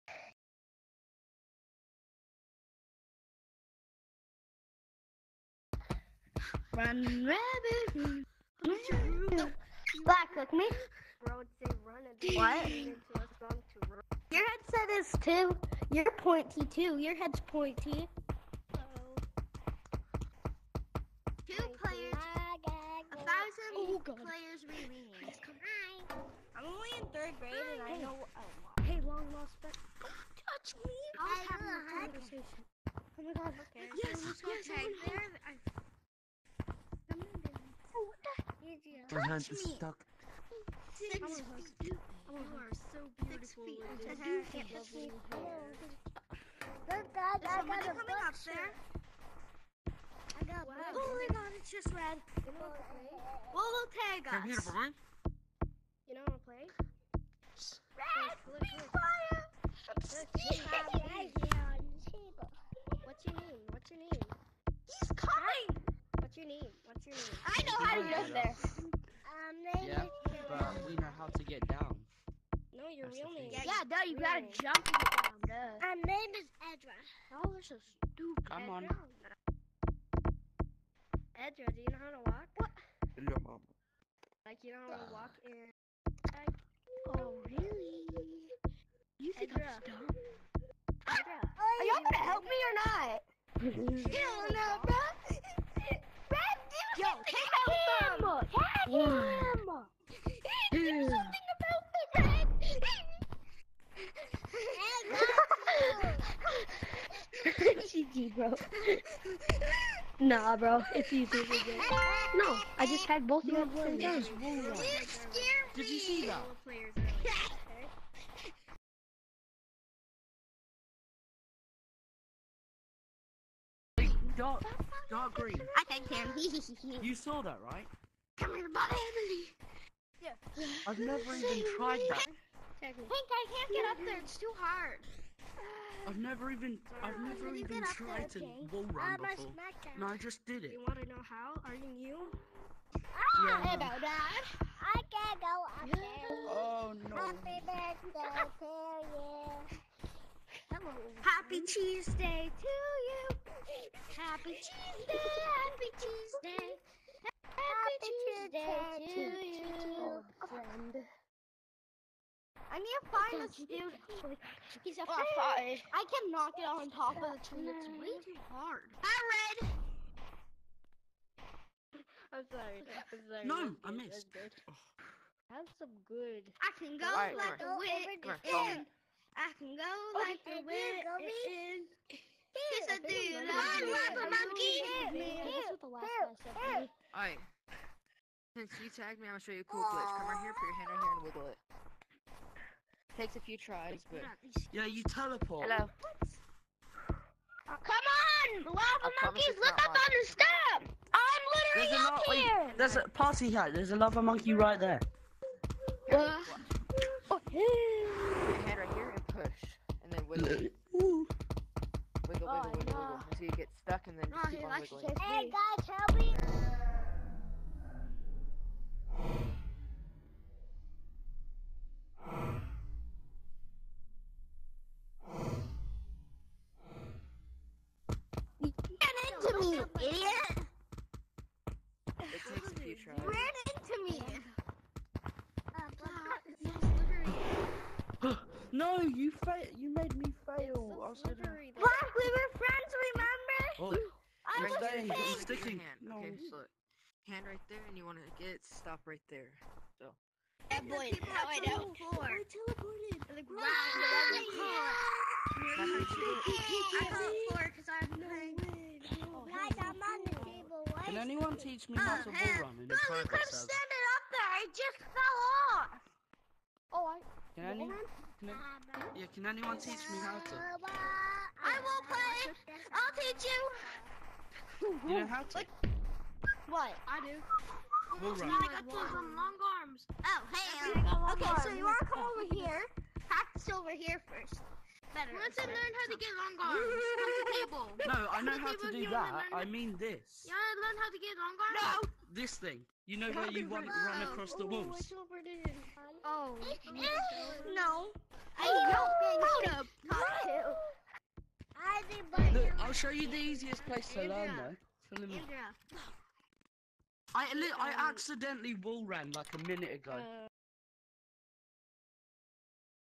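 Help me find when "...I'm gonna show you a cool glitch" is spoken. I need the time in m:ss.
3:09.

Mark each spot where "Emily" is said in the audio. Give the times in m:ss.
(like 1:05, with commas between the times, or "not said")
2:09.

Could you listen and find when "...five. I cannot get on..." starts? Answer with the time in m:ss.
2:45.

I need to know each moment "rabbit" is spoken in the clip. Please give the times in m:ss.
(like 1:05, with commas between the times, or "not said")
0:07.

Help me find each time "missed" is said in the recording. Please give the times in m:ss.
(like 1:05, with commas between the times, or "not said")
2:53.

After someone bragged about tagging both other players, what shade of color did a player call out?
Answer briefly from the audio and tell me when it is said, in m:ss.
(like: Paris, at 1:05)
dark green, at 2:04.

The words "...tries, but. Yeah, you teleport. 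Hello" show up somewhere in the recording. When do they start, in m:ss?
3:13.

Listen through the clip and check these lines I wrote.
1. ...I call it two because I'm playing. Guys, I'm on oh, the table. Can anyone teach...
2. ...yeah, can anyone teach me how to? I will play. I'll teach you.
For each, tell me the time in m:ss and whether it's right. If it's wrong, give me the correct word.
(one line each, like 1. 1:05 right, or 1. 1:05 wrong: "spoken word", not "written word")
1. 4:15 wrong: "four", not "two"
2. 4:29 right.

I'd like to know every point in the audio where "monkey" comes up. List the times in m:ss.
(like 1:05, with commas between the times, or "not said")
3:04, 3:19, 3:24.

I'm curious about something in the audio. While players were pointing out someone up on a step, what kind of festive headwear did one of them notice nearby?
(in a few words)
party hat.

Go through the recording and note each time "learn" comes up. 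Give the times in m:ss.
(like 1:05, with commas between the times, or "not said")
4:45, 4:50, 5:04.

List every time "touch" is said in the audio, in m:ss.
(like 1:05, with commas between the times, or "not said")
0:30, 0:44.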